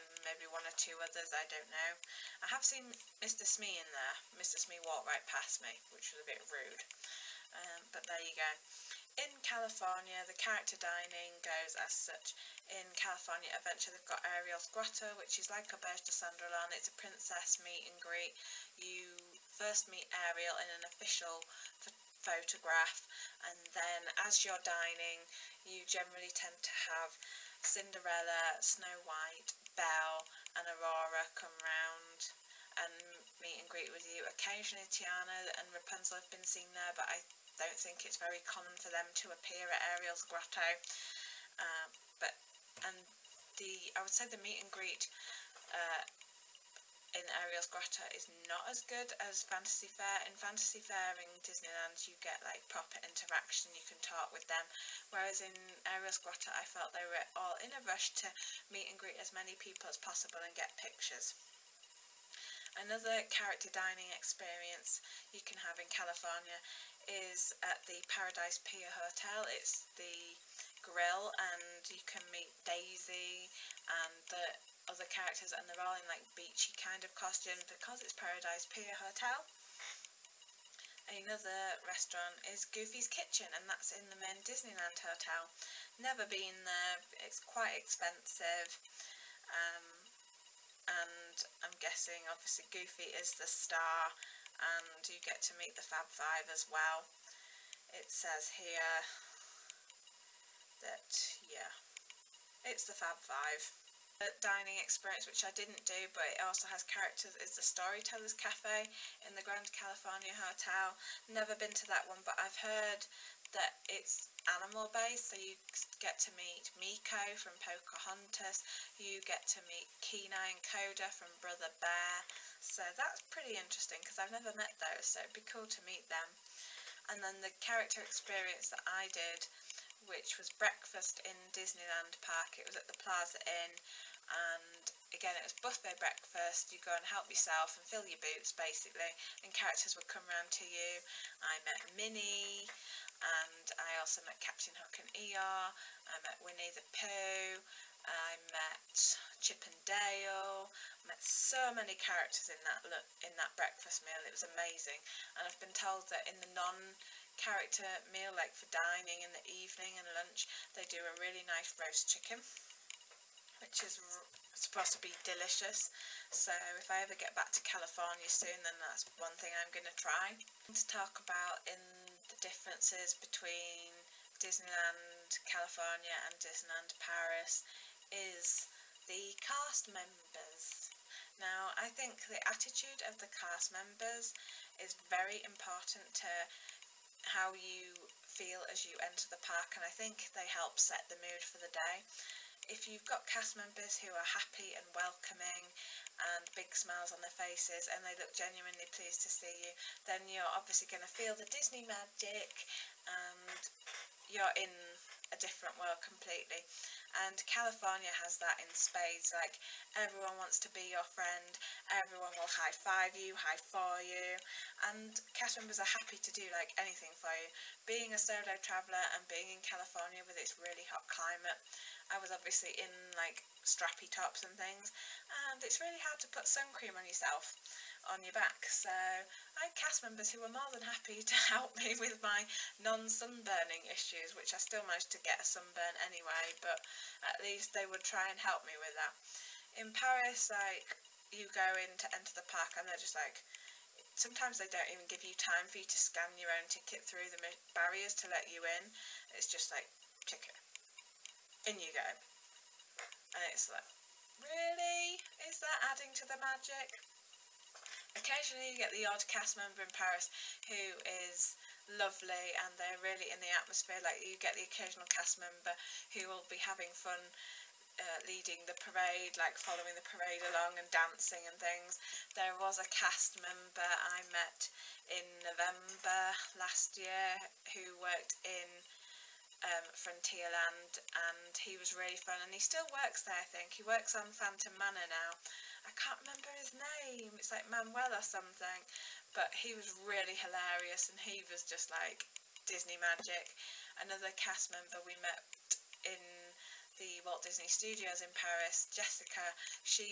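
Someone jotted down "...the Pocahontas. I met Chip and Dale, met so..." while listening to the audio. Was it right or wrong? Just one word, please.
wrong.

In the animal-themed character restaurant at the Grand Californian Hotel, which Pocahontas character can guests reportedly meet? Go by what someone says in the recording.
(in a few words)
Meeko.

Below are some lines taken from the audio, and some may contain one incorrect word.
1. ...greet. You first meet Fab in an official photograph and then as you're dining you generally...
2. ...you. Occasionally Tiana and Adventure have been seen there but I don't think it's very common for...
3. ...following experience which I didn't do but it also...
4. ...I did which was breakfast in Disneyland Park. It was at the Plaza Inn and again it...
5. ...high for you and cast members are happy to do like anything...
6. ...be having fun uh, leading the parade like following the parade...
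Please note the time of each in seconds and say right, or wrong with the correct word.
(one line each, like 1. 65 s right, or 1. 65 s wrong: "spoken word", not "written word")
1. 17 s wrong: "Ariel", not "Fab"
2. 34 s wrong: "Rapunzel", not "Adventure"
3. 104 s wrong: "dining", not "following"
4. 128 s right
5. 213 s right
6. 266 s right.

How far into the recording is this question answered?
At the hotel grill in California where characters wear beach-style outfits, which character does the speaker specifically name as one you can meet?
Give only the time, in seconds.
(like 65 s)
72 s.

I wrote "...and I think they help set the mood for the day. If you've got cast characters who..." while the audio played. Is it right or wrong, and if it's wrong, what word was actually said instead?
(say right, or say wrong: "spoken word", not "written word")
wrong: "members", not "characters".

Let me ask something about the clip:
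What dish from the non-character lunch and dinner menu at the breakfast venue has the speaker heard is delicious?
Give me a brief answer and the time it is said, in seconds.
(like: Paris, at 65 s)
roast chicken, at 161 s.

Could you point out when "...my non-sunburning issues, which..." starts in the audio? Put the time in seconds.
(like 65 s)
232 s.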